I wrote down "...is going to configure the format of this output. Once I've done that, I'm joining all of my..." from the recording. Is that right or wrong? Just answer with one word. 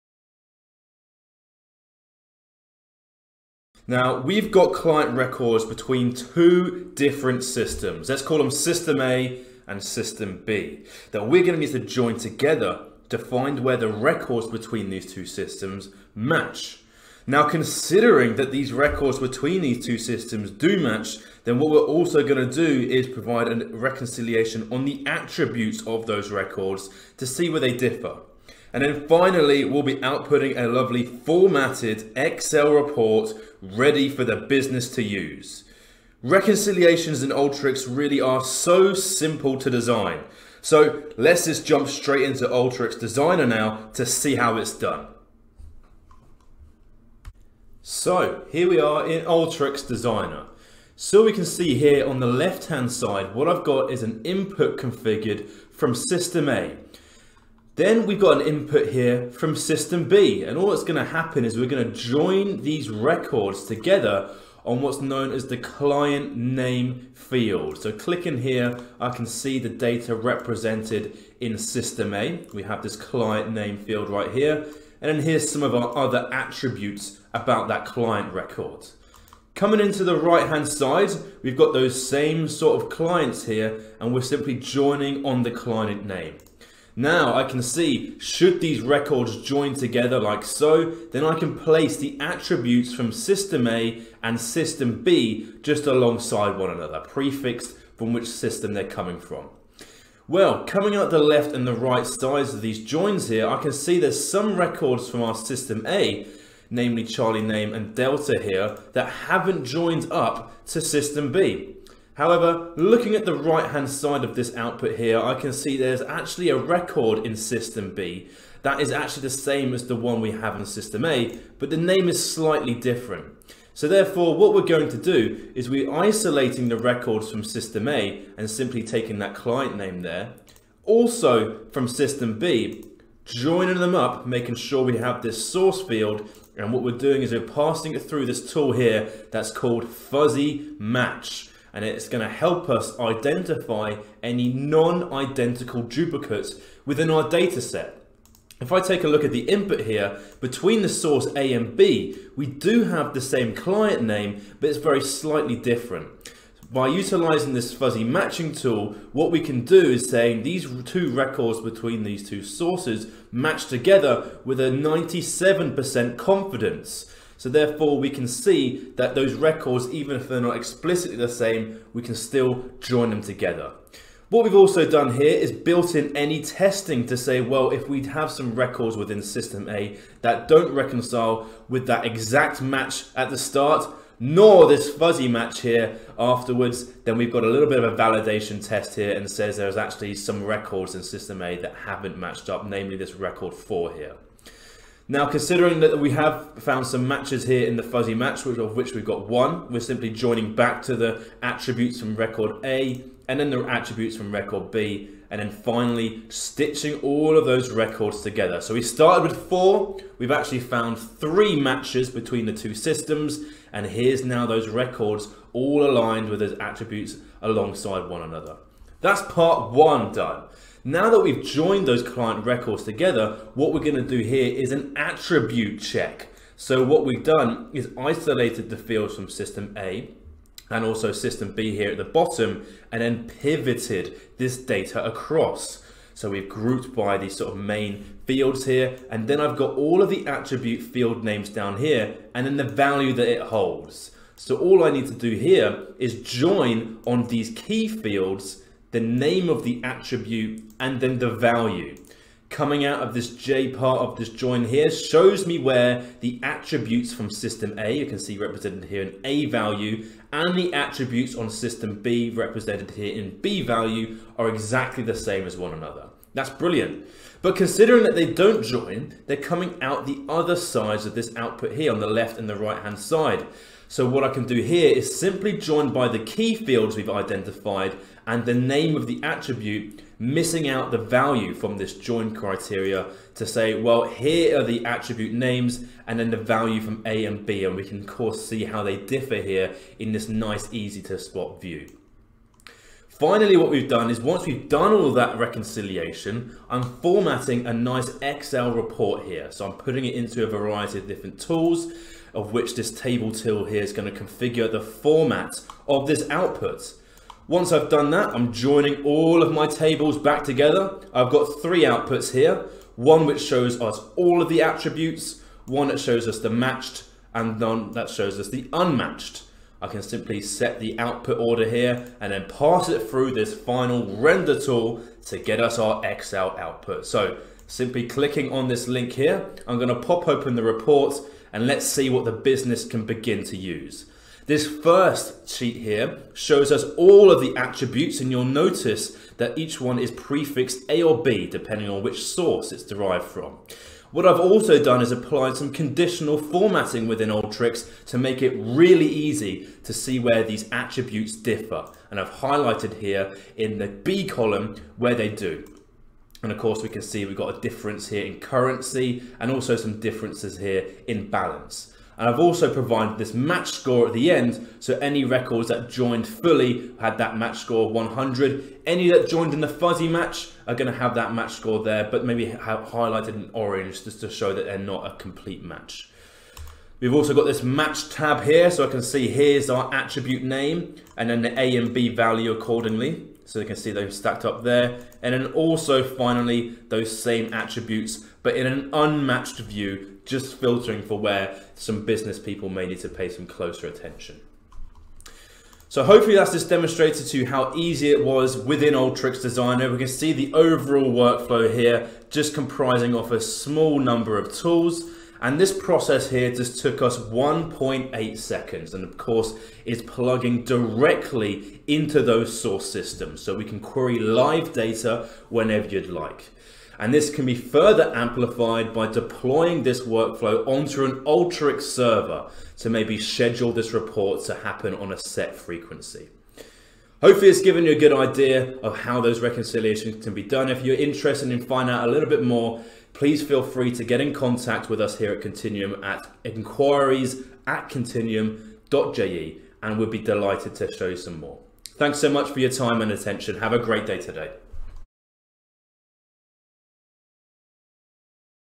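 right.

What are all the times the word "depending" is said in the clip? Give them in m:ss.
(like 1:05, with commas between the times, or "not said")
5:41.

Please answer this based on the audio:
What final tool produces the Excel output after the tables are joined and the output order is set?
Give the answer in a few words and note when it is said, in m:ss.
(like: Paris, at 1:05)
render tool, at 5:24.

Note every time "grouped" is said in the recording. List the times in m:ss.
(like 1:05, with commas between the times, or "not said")
3:56.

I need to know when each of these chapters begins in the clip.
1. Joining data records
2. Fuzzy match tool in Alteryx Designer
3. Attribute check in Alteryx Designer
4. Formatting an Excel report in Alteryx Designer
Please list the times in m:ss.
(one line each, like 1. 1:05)
1. 0:37
2. 1:40
3. 3:40
4. 4:51.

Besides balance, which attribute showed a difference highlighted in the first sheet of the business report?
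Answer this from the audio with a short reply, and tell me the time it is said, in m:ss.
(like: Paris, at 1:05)
currency, at 5:58.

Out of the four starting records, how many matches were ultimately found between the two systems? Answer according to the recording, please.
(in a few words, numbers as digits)
3.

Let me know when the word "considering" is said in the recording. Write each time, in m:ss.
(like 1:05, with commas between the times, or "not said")
0:17, 3:15, 4:27.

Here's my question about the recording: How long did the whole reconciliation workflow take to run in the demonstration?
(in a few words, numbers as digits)
1.8 seconds.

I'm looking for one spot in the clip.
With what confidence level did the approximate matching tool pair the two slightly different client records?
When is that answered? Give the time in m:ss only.
2:44.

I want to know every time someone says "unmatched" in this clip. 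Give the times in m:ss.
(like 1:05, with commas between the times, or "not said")
5:18, 6:28.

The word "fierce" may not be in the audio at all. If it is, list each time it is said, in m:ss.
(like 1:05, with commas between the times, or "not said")
not said.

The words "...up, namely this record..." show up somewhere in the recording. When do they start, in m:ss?
3:12.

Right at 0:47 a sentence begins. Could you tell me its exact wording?
So here we are in Alteryx Designer.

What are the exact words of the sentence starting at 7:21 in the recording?
Thanks so much for your time and attention.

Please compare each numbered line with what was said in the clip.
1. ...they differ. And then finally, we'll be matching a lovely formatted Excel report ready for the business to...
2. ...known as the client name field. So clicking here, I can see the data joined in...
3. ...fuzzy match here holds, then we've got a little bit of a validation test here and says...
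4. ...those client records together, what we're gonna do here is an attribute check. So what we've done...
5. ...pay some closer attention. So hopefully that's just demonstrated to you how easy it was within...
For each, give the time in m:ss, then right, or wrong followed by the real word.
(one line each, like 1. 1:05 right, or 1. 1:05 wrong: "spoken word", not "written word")
1. 0:27 wrong: "outputting", not "matching"
2. 1:05 wrong: "represented", not "joined"
3. 3:04 wrong: "afterwards", not "holds"
4. 3:41 right
5. 6:33 right.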